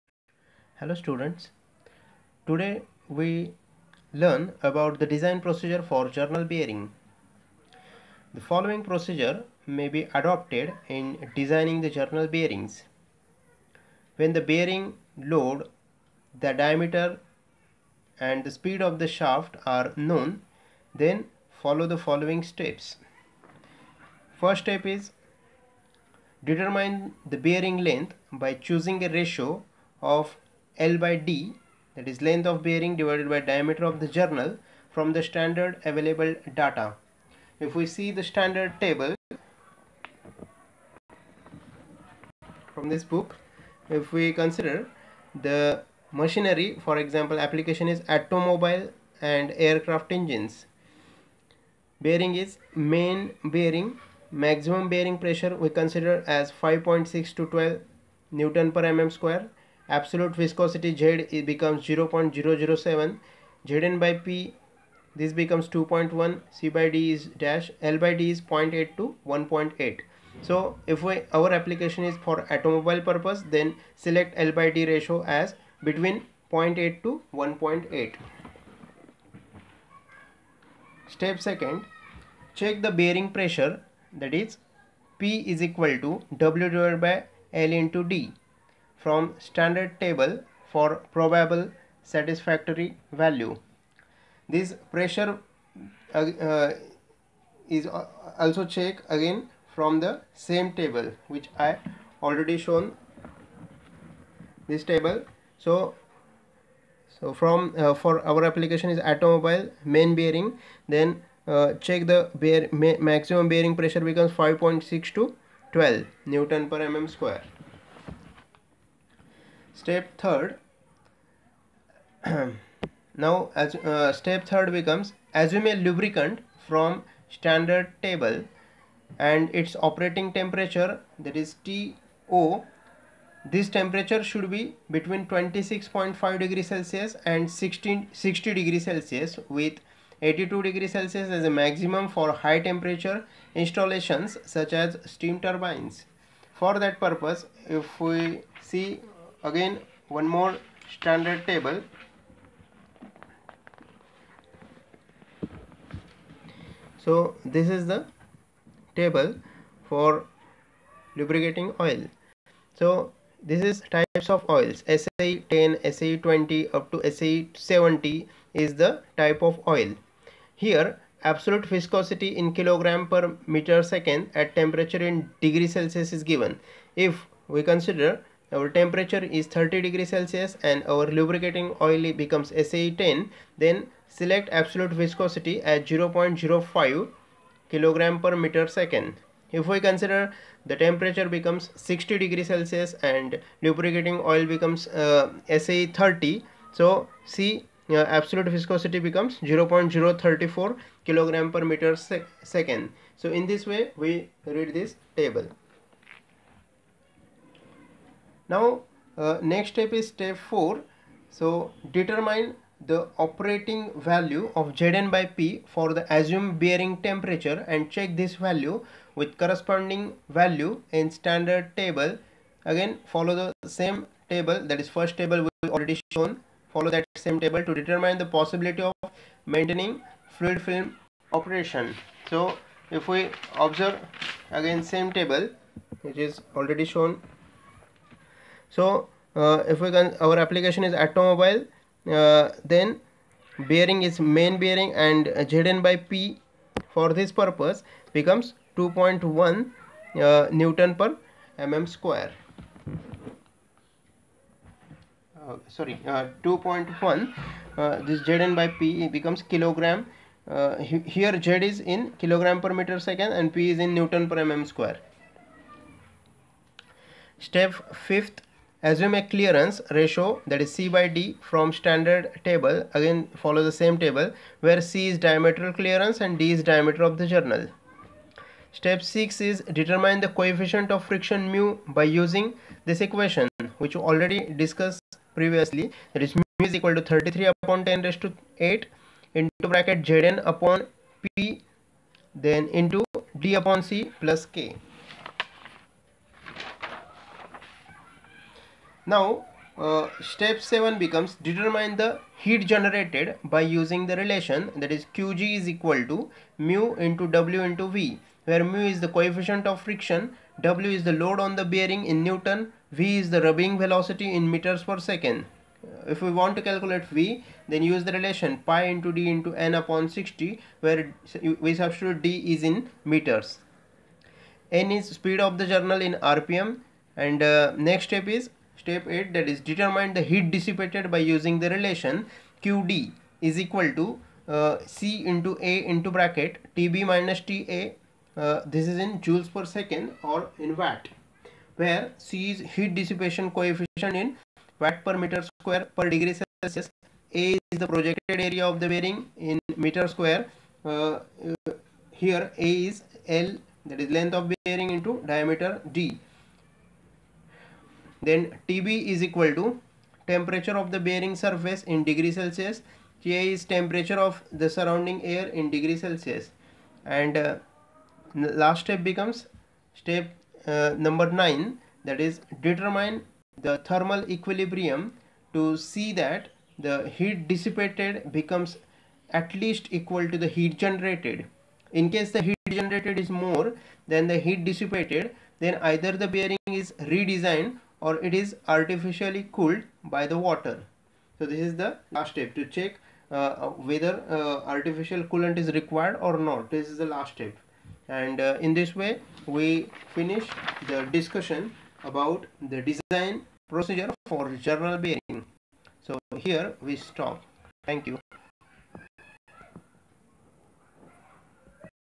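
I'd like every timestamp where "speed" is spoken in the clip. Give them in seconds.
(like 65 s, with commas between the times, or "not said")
18 s, 325 s.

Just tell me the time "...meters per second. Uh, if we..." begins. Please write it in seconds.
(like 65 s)
314 s.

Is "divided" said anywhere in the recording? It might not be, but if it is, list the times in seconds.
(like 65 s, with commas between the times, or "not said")
32 s, 86 s.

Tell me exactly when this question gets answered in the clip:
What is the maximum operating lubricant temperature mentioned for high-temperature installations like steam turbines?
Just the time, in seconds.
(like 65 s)
140 s.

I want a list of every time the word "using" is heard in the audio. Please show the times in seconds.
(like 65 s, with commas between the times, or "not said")
282 s, 303 s, 331 s.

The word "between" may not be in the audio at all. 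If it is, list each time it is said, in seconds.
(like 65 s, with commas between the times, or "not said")
75 s, 134 s.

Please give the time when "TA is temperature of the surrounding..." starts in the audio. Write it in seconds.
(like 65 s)
363 s.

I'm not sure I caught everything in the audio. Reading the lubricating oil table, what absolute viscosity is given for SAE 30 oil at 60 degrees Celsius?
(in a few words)
0.034 kg/m·s.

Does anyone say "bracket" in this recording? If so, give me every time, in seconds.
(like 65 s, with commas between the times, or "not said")
289 s, 336 s.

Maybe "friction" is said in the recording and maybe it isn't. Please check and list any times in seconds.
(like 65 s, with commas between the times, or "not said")
281 s, 309 s.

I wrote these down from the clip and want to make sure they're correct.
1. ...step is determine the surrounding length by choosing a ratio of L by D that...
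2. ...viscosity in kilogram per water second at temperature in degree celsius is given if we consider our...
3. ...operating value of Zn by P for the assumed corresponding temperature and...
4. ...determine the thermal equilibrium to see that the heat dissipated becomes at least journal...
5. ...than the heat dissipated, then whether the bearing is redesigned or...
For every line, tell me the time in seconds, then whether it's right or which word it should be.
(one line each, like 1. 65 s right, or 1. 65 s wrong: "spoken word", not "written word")
1. 24 s wrong: "bearing", not "surrounding"
2. 171 s wrong: "meter", not "water"
3. 213 s wrong: "bearing", not "corresponding"
4. 372 s wrong: "equal", not "journal"
5. 384 s wrong: "either", not "whether".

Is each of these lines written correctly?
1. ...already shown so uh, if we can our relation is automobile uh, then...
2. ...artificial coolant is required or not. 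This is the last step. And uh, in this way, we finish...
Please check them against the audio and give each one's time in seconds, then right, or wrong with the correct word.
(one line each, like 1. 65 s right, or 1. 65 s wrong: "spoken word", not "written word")
1. 236 s wrong: "application", not "relation"
2. 394 s right.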